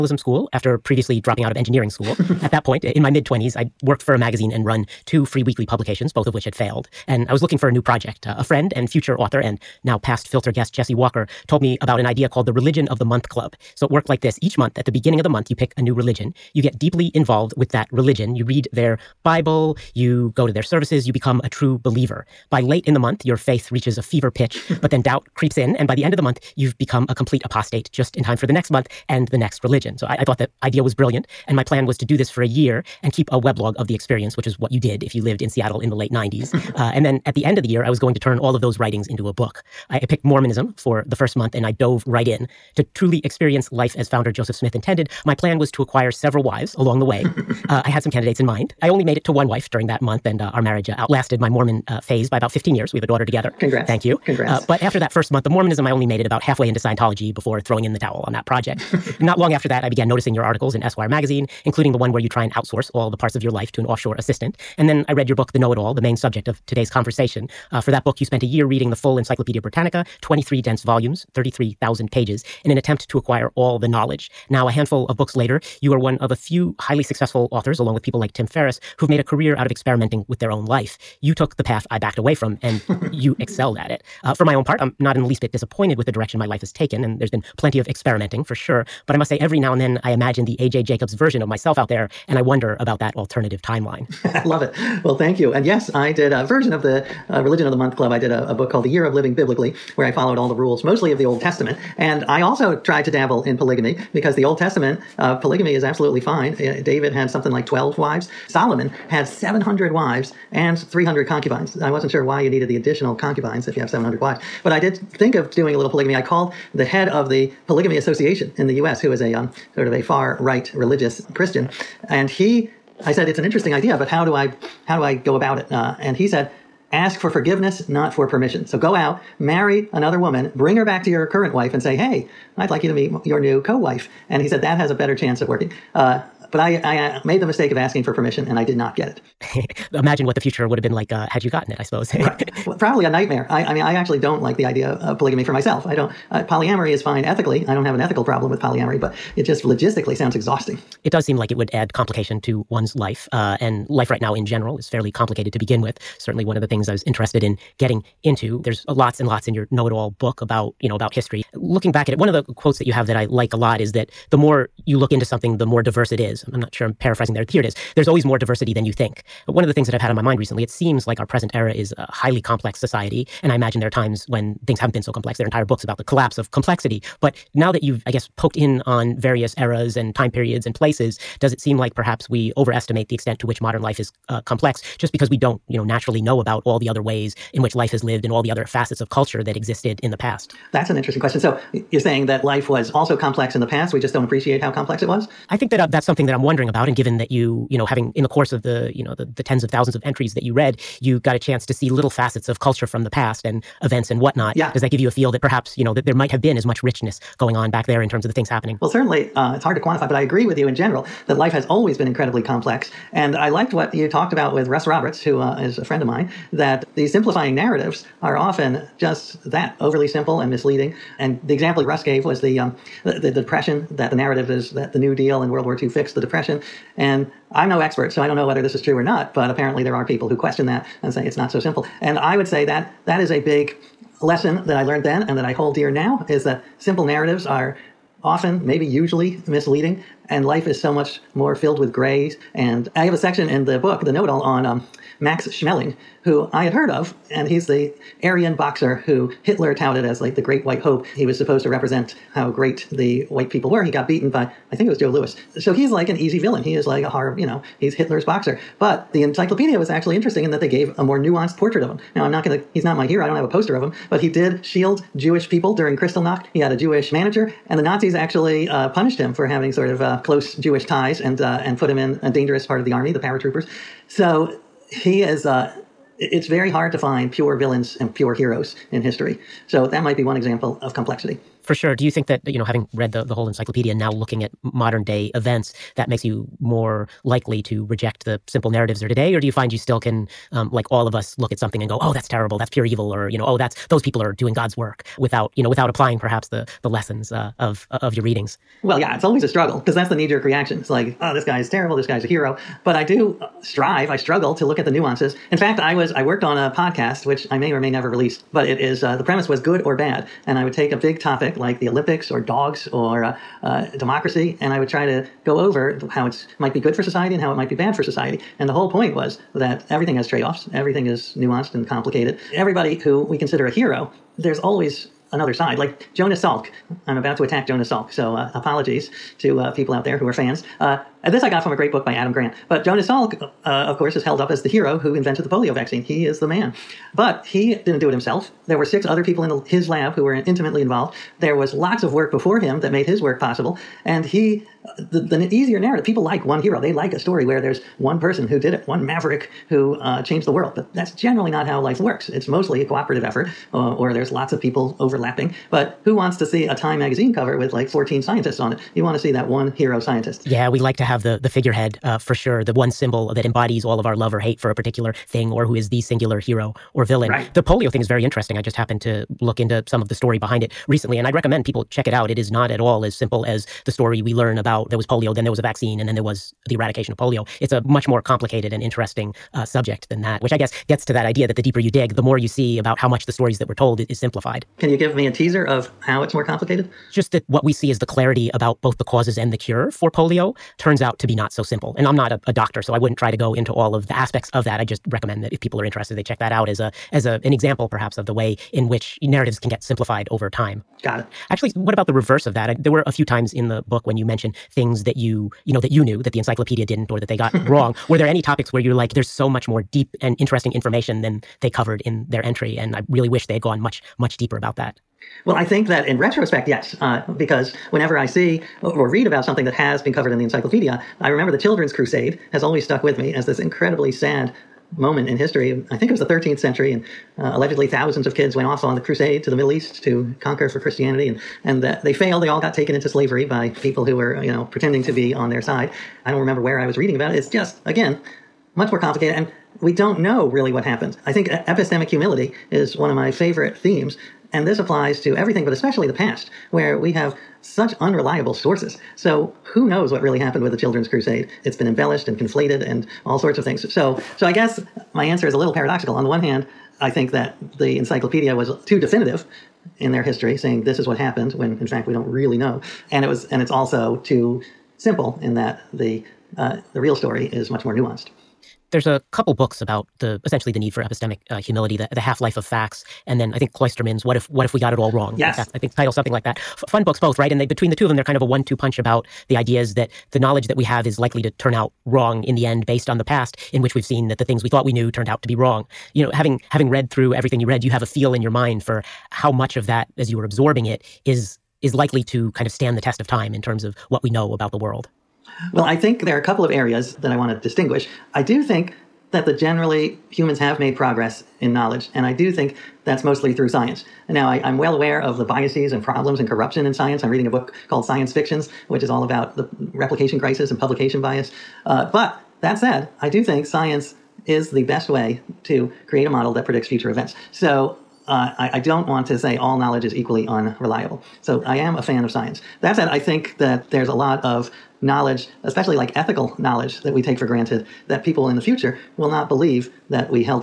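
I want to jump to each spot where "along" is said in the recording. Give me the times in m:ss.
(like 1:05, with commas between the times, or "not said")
0:46, 1:17.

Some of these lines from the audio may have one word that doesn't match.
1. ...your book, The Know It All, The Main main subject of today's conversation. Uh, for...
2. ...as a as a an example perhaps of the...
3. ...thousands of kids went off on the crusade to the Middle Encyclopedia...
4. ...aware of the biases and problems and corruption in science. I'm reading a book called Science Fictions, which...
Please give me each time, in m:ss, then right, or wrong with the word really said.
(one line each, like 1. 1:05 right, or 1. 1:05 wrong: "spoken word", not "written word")
1. 1:05 right
2. 6:36 right
3. 7:07 wrong: "East", not "Encyclopedia"
4. 8:24 right.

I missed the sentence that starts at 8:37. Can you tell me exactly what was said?
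So uh, I, I, don't want to say all knowledge is equally unreliable.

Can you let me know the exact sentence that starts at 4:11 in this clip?
He was supposed to represent how great the white people were.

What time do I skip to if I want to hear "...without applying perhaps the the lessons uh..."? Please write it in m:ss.
4:55.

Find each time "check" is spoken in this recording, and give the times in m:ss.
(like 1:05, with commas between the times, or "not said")
6:11, 6:36.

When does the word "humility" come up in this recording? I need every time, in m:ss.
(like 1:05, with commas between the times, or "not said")
7:22, 7:51.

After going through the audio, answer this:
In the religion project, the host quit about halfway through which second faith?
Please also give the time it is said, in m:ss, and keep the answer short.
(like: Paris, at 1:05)
Scientology, at 0:56.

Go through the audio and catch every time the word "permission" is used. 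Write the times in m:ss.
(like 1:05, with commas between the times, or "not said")
2:08, 2:18.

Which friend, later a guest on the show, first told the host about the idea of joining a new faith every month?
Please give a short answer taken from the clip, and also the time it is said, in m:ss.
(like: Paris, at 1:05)
Jesse Walker, at 0:10.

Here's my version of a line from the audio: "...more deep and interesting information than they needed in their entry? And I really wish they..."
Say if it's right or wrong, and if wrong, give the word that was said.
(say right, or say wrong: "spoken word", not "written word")
wrong: "covered", not "needed".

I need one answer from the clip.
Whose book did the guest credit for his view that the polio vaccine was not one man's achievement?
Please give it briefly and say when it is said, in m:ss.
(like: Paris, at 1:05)
Adam Grant, at 5:32.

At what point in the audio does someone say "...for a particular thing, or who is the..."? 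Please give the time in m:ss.
6:04.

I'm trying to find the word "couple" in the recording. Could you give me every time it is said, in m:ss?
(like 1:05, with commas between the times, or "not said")
7:49, 8:16.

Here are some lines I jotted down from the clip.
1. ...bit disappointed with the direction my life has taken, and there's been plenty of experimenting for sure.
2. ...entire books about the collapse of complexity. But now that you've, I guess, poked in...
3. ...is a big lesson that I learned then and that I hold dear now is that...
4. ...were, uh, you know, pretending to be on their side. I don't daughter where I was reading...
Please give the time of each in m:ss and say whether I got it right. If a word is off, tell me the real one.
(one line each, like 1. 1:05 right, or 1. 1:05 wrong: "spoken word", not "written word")
1. 1:25 right
2. 2:55 right
3. 3:53 right
4. 7:14 wrong: "remember", not "daughter".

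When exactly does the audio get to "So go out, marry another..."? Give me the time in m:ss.
2:08.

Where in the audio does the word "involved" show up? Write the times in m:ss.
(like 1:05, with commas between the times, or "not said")
0:17, 5:40.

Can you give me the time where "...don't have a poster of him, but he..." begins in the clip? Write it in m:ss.
4:23.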